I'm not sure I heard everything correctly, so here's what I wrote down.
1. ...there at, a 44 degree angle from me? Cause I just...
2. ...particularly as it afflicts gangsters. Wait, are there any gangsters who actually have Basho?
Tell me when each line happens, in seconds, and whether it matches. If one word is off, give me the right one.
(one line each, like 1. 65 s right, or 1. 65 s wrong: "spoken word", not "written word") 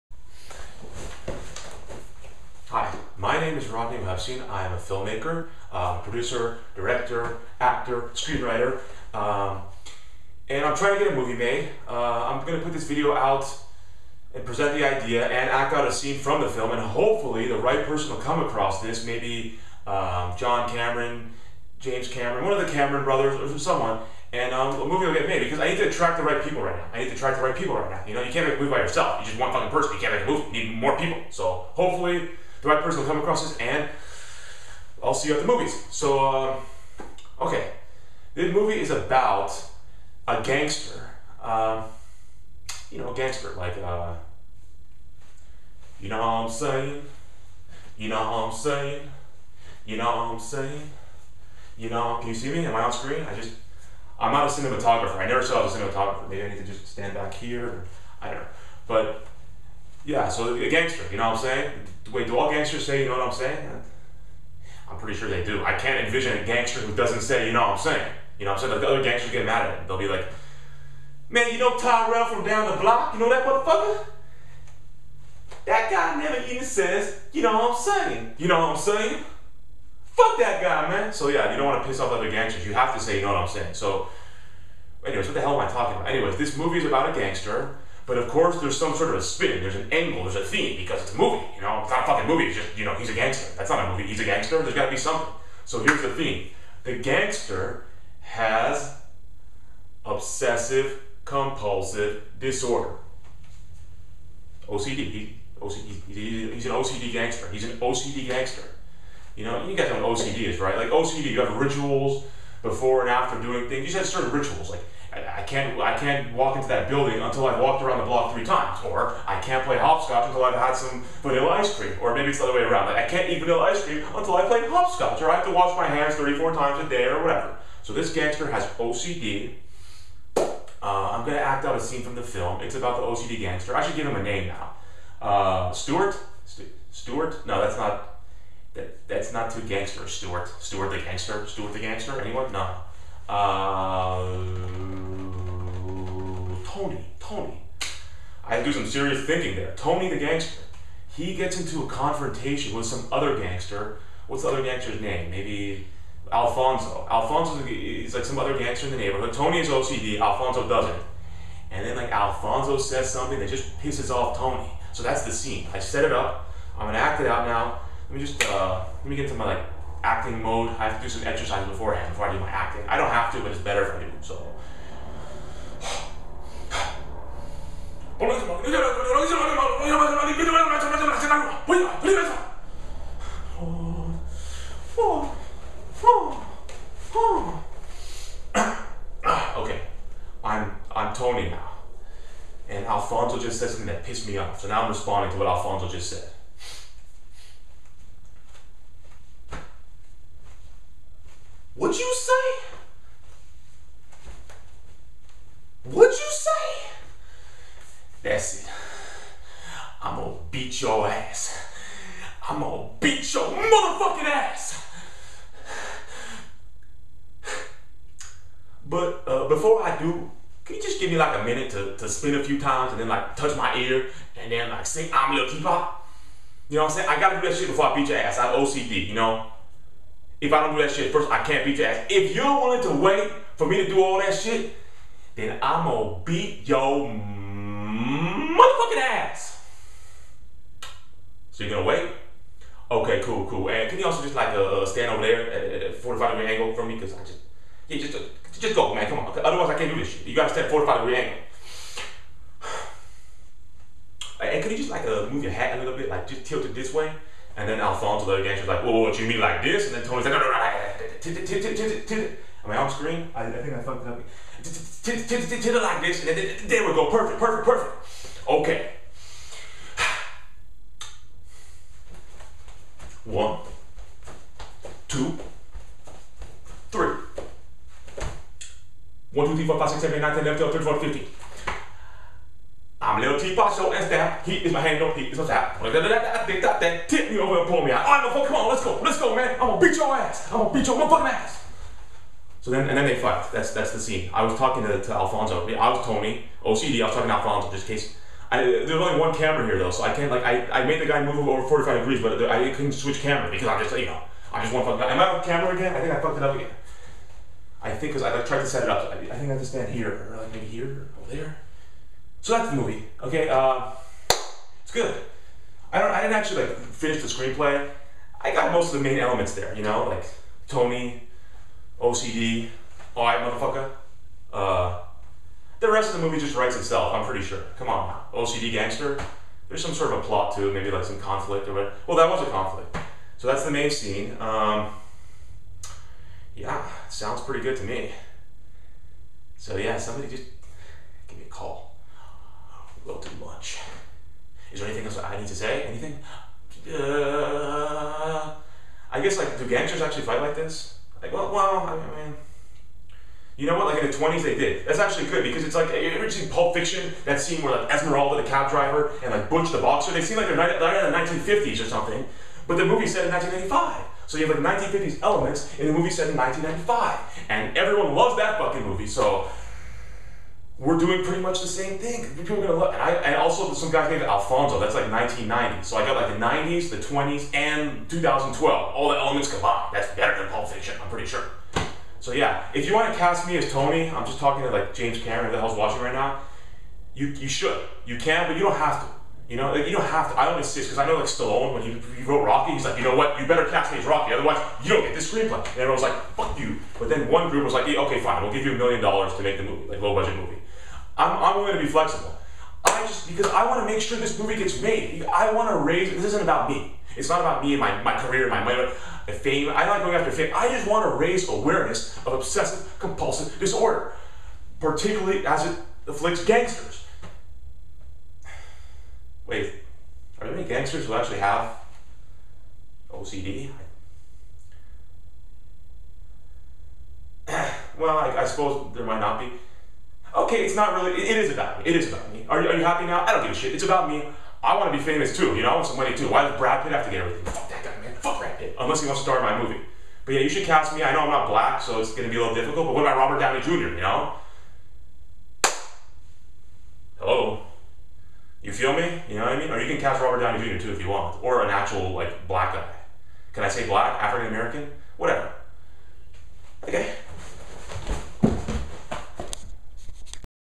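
1. 245 s wrong: "45", not "44"
2. 414 s wrong: "OCD", not "Basho".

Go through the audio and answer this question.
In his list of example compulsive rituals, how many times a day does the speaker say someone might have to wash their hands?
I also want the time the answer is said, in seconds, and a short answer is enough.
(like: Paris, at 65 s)
34, at 126 s.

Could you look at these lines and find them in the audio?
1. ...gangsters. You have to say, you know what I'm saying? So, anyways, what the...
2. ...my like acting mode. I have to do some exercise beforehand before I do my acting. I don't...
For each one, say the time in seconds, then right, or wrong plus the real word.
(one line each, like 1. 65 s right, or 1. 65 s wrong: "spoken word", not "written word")
1. 82 s right
2. 169 s right.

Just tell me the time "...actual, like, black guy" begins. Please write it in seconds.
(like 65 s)
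451 s.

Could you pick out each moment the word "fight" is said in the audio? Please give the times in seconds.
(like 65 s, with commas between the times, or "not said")
293 s, 350 s.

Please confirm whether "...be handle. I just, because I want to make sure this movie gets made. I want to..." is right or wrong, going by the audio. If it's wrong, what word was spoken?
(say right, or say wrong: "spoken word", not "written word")
wrong: "flexible", not "handle".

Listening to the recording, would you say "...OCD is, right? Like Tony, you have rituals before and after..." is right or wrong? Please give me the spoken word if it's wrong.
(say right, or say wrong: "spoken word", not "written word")
wrong: "OCD", not "Tony".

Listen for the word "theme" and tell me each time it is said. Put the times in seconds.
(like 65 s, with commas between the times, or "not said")
90 s, 96 s.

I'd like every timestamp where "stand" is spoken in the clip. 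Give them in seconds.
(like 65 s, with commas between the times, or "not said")
56 s, 244 s, 250 s, 309 s.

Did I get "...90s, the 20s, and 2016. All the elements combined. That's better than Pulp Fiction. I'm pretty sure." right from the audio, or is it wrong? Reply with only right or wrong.
wrong.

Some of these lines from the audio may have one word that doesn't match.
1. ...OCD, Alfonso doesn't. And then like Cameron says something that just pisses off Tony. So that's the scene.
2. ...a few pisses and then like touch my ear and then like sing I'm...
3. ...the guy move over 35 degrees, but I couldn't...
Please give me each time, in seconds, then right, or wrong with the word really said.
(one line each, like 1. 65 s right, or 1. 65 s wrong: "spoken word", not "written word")
1. 159 s wrong: "Alfonso", not "Cameron"
2. 222 s wrong: "times", not "pisses"
3. 301 s wrong: "45", not "35".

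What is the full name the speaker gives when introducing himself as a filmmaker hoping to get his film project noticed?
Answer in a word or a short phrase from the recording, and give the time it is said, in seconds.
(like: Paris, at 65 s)
Rodney Webstein, at 3 s.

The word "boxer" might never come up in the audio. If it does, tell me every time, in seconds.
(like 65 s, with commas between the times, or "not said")
359 s.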